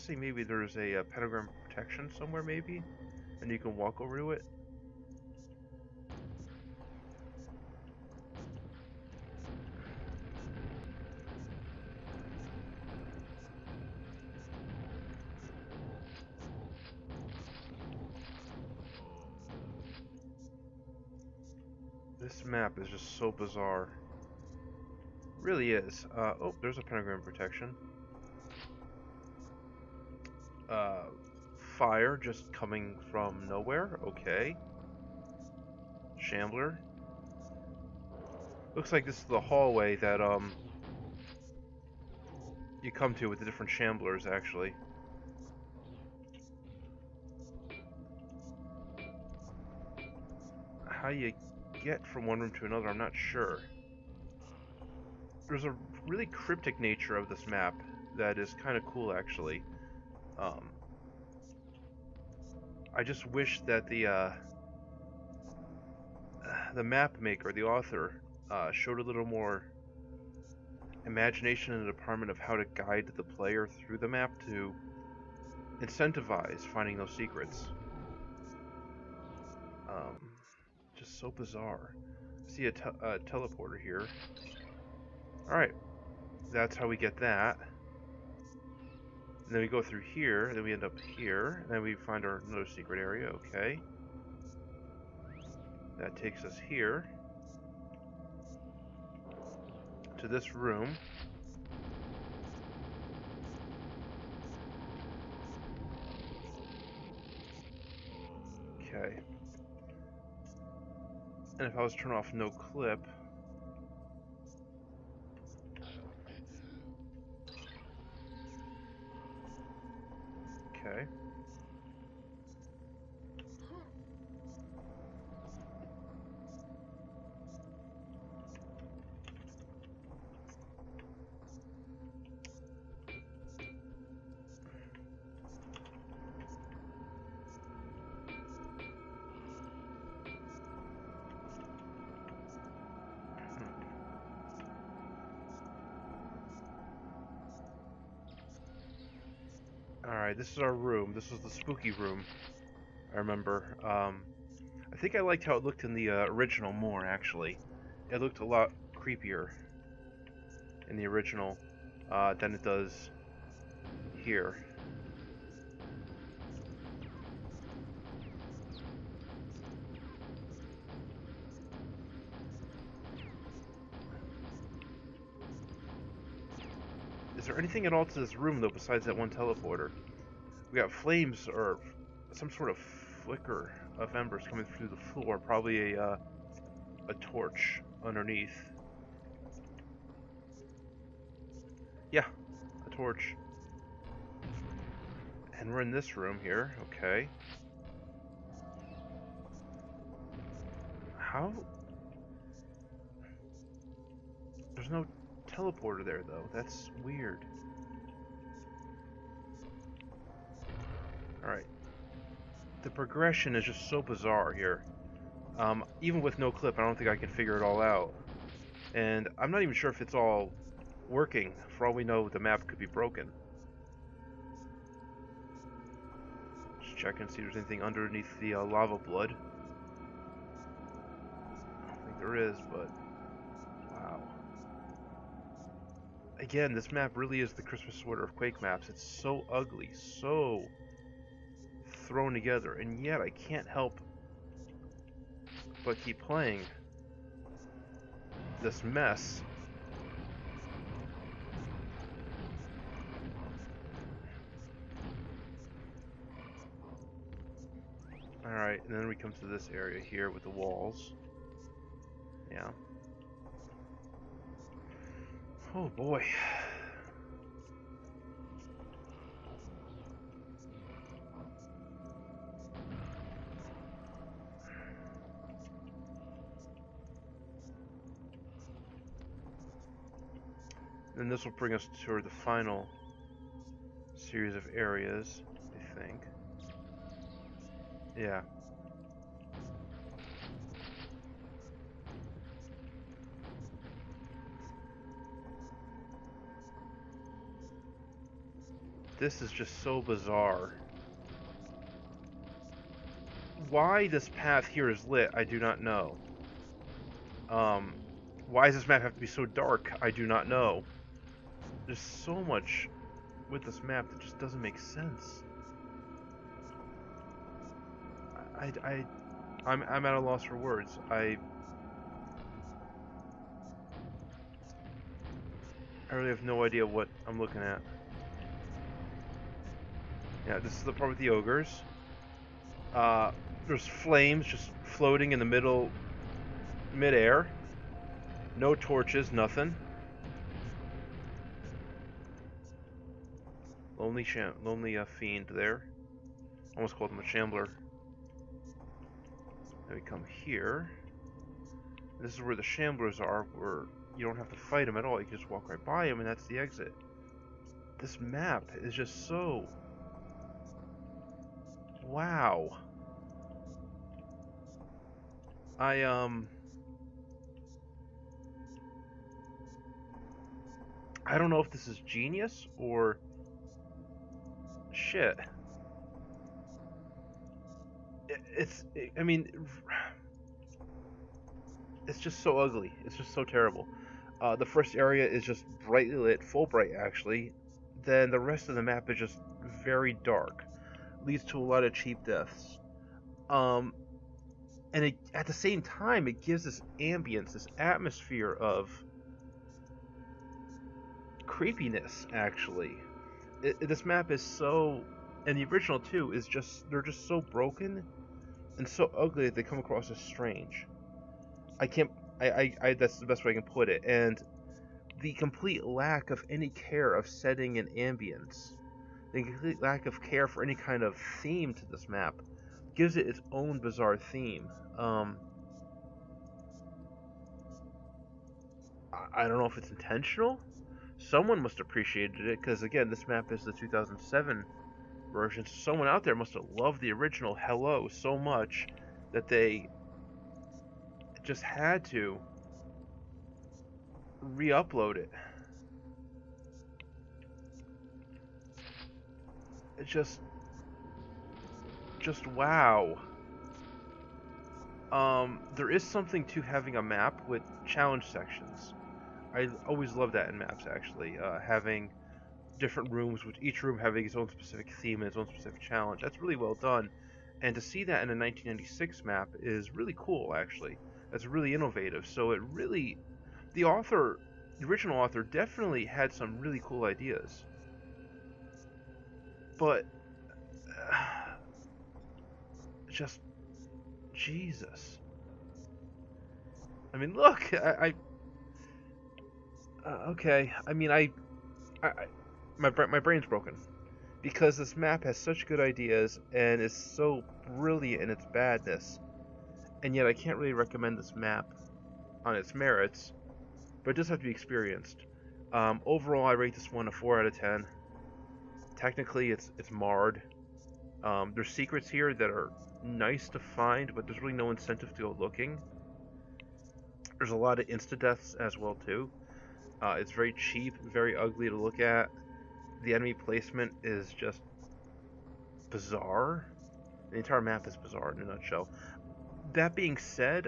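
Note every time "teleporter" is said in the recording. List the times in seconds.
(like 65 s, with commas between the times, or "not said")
83 s, 179 s, 205 s.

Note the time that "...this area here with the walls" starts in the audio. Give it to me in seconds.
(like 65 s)
259 s.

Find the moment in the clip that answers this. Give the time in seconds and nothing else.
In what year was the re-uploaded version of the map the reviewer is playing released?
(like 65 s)
433 s.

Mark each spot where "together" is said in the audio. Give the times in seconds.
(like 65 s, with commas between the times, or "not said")
242 s.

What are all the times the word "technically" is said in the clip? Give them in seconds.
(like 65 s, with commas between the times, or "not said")
508 s.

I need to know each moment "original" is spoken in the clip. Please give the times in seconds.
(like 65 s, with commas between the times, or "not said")
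156 s, 161 s, 405 s, 437 s, 474 s.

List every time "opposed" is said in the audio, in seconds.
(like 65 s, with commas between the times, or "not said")
not said.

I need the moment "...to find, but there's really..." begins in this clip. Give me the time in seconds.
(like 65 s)
513 s.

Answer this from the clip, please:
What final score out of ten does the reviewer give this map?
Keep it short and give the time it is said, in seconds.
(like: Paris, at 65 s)
4, at 507 s.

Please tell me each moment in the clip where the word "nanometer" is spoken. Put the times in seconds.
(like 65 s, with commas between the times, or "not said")
not said.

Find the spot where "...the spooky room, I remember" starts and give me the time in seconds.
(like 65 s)
151 s.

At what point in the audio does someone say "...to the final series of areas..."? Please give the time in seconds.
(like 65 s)
282 s.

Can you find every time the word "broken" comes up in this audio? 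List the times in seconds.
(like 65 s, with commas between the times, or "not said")
222 s, 407 s, 493 s.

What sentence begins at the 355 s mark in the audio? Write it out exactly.
You can just walk right by them, and that's the exit.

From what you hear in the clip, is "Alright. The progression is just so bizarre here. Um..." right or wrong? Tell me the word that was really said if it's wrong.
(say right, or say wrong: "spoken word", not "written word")
right.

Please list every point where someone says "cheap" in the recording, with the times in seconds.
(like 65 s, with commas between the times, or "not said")
391 s, 520 s.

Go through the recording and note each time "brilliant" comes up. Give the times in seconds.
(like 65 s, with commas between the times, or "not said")
497 s.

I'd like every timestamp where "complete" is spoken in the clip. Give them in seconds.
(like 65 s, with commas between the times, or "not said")
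415 s, 419 s.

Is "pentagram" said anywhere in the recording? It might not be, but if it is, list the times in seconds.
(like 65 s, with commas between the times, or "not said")
1 s, 26 s.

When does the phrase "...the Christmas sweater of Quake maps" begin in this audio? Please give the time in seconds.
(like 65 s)
237 s.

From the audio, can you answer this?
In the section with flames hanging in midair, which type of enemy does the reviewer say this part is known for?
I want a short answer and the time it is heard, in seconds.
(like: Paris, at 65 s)
Ogres, at 331 s.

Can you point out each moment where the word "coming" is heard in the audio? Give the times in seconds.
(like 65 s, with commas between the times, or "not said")
32 s, 184 s.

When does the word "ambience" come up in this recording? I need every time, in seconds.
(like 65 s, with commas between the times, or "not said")
396 s, 417 s.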